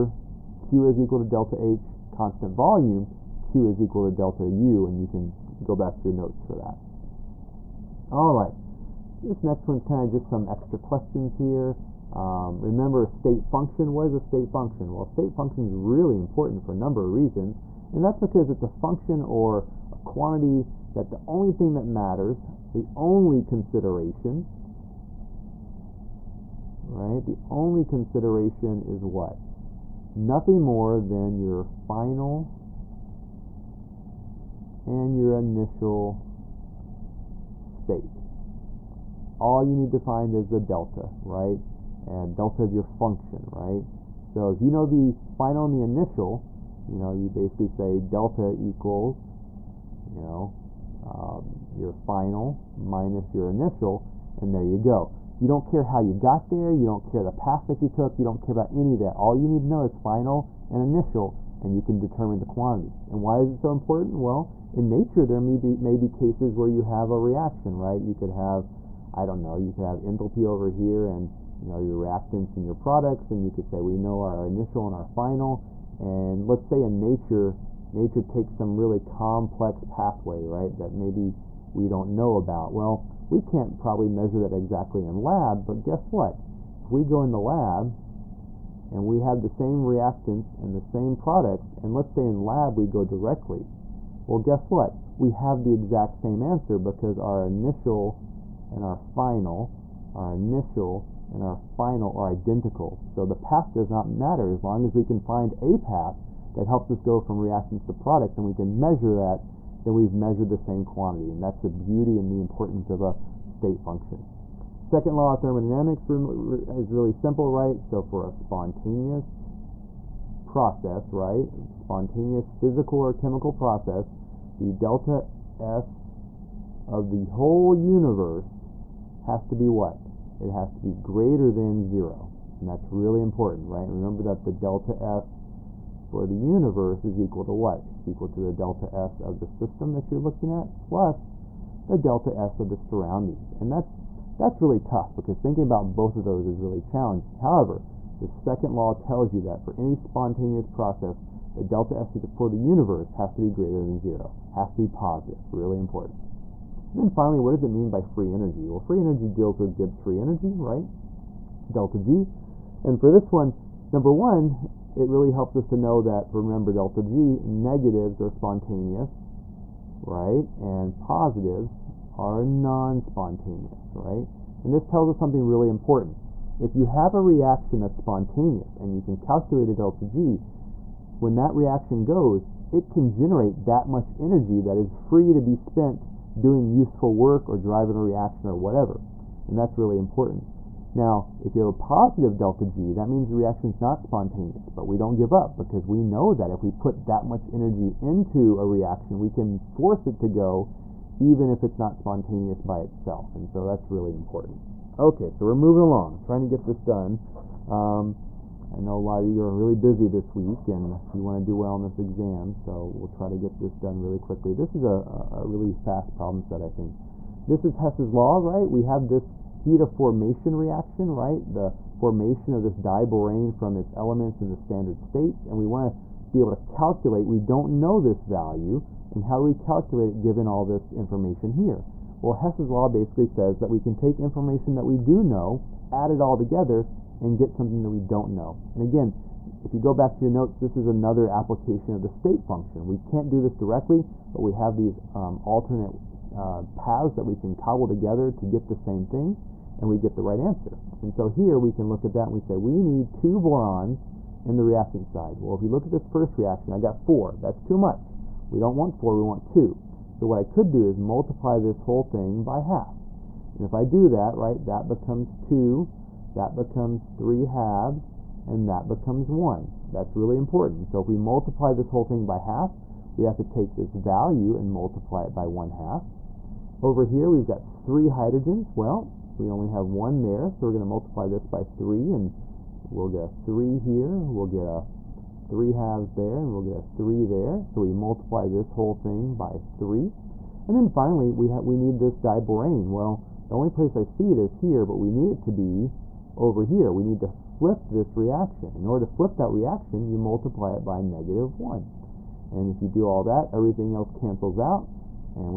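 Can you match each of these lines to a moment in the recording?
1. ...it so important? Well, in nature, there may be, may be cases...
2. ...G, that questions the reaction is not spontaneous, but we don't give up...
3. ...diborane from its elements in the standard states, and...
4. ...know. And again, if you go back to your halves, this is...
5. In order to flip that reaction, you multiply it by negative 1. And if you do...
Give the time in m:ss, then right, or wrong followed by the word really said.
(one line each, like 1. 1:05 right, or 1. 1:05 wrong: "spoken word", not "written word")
1. 1:03 right
2. 3:12 wrong: "means", not "questions"
3. 3:42 right
4. 3:58 wrong: "notes", not "halves"
5. 4:58 right.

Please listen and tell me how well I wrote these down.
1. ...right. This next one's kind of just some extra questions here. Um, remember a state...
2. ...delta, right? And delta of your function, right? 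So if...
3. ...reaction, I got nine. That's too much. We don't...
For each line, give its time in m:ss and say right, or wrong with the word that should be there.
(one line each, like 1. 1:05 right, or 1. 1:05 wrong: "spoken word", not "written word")
1. 0:08 right
2. 0:40 right
3. 4:16 wrong: "four", not "nine".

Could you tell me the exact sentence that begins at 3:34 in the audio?
This is a, a really fast problem set, I think.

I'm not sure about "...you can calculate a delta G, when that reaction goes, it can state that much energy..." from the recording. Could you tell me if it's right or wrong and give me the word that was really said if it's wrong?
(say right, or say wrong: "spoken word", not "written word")
wrong: "generate", not "state".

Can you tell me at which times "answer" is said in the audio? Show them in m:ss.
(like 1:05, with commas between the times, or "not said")
1:36, 4:10.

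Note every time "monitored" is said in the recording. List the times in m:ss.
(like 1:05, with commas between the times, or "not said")
not said.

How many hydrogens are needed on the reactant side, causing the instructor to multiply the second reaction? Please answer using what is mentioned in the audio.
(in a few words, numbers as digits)
3.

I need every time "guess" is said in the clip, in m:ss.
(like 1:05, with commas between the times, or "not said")
1:25, 1:34.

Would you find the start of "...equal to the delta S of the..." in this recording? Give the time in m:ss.
2:18.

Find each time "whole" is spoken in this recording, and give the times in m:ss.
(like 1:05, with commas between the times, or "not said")
2:07, 4:21, 4:31, 4:48.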